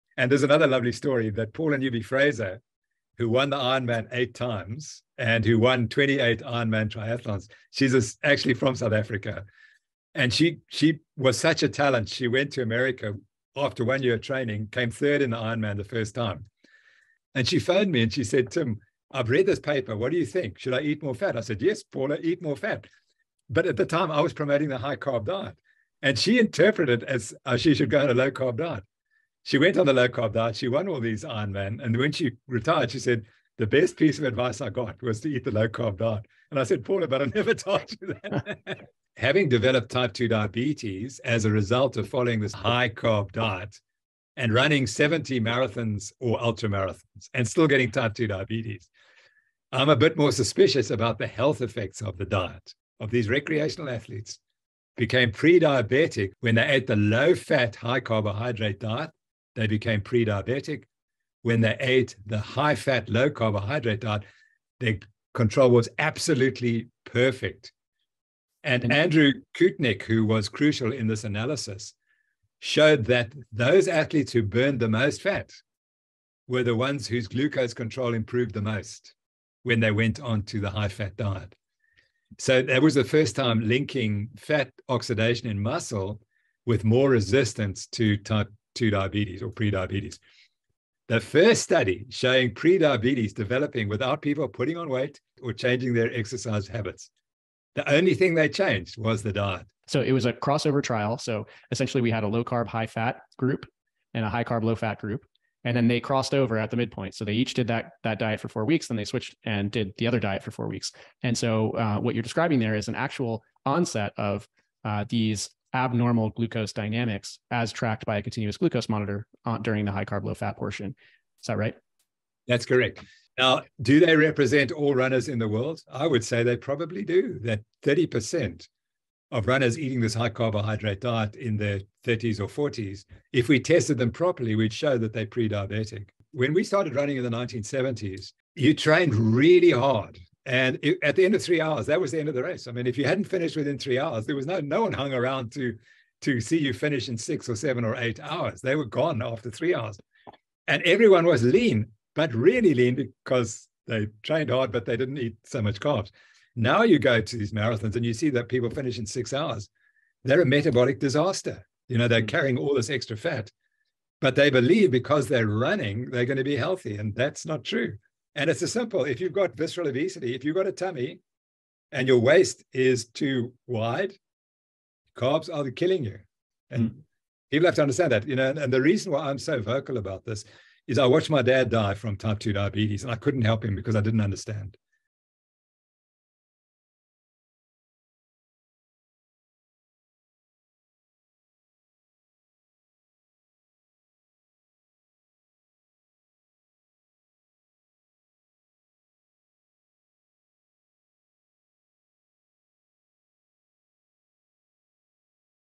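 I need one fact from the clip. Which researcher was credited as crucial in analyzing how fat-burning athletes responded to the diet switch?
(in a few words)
Andrew Koutnik.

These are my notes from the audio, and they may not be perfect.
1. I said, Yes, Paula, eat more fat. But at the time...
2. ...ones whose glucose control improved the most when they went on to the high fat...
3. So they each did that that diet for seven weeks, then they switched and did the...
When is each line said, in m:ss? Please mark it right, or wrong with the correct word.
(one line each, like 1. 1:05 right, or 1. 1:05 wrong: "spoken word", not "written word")
1. 0:21 right
2. 1:16 right
3. 1:47 wrong: "four", not "seven".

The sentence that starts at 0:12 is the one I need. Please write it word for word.
She went to America after one year of training, came third in the Ironman the first time.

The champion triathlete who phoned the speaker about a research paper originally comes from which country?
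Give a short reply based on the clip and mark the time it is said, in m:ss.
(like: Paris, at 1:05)
South Africa, at 0:08.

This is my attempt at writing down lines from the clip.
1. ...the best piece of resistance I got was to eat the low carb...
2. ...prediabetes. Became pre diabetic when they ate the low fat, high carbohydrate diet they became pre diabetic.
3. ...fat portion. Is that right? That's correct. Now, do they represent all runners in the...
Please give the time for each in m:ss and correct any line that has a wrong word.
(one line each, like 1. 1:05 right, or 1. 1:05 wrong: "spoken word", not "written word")
1. 0:33 wrong: "advice", not "resistance"
2. 0:53 wrong: "athletes", not "prediabetes"
3. 2:00 right.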